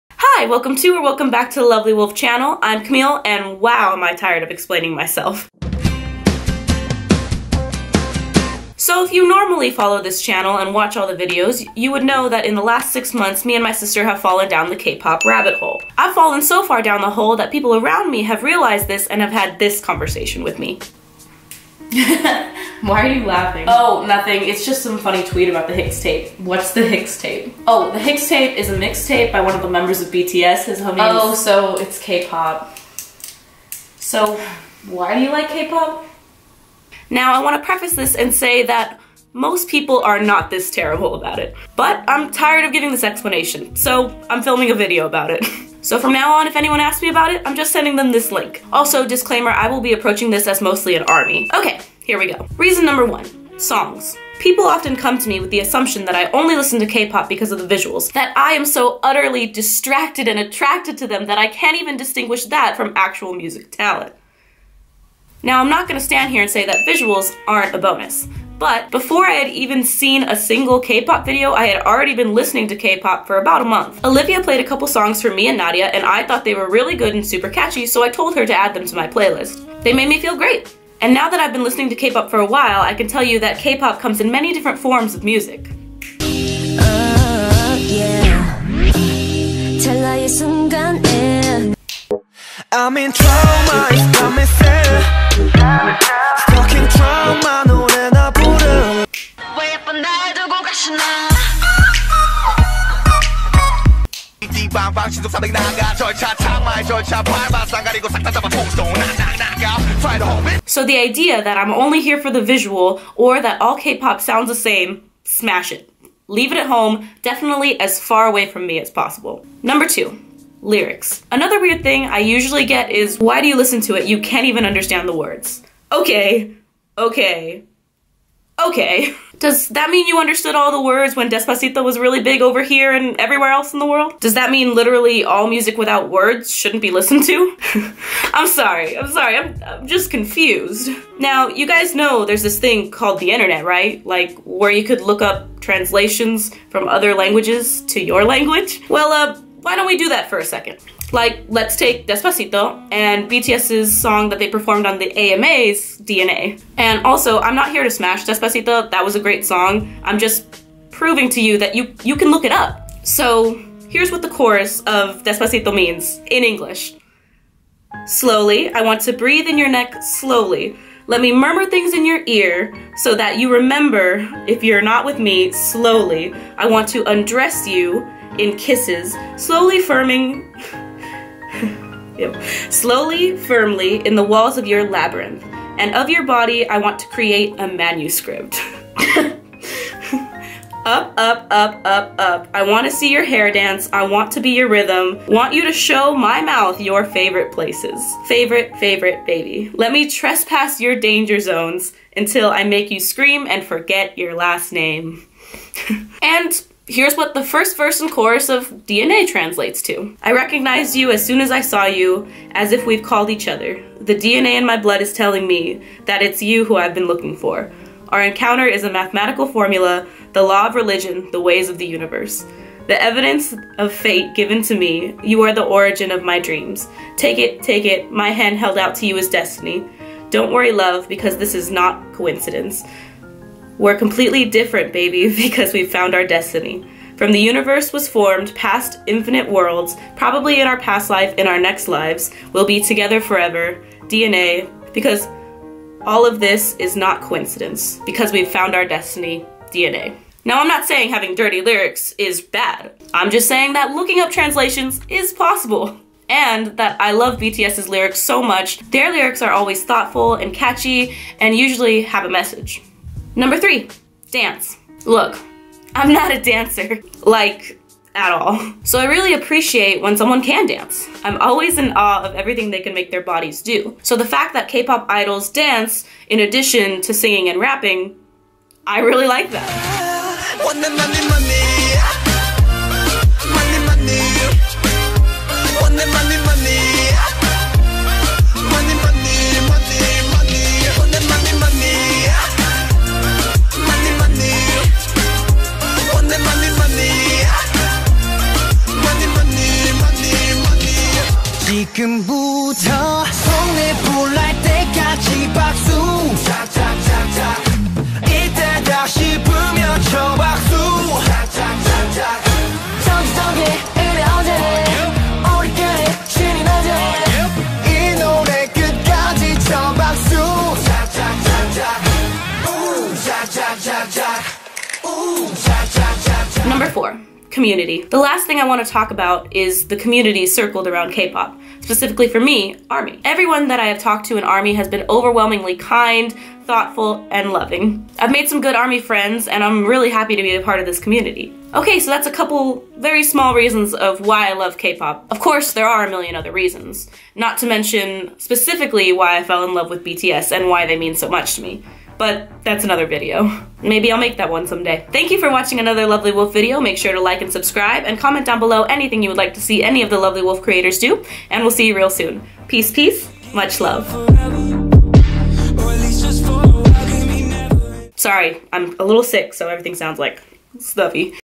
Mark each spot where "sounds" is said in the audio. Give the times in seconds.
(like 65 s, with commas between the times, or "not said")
114 s, 369 s.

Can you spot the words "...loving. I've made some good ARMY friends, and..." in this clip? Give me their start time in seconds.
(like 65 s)
337 s.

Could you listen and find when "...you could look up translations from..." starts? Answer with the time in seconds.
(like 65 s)
144 s.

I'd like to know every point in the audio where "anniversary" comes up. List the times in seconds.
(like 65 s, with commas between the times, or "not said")
not said.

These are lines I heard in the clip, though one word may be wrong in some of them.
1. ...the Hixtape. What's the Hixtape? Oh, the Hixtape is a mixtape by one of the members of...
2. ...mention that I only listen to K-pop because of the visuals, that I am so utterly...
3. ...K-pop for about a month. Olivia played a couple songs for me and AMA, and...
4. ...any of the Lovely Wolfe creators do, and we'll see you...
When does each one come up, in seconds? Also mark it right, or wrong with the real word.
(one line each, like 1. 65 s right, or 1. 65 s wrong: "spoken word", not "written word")
1. 25 s right
2. 55 s wrong: "assumption", not "mention"
3. 72 s wrong: "Nadia", not "AMA"
4. 359 s right.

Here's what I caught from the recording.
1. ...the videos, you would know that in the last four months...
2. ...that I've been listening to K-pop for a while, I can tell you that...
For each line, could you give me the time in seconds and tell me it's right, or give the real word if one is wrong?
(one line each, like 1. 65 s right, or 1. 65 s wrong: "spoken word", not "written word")
1. 11 s wrong: "six", not "four"
2. 81 s right.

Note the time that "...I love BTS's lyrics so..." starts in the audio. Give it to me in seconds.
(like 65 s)
257 s.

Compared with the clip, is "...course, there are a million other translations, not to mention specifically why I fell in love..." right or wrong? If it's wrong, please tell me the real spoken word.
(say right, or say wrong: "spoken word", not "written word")
wrong: "reasons", not "translations".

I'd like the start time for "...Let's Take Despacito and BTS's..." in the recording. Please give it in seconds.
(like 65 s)
151 s.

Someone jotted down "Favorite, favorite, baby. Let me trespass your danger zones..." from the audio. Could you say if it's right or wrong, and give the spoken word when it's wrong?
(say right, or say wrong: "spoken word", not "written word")
right.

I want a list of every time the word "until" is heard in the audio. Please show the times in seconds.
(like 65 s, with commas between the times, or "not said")
202 s.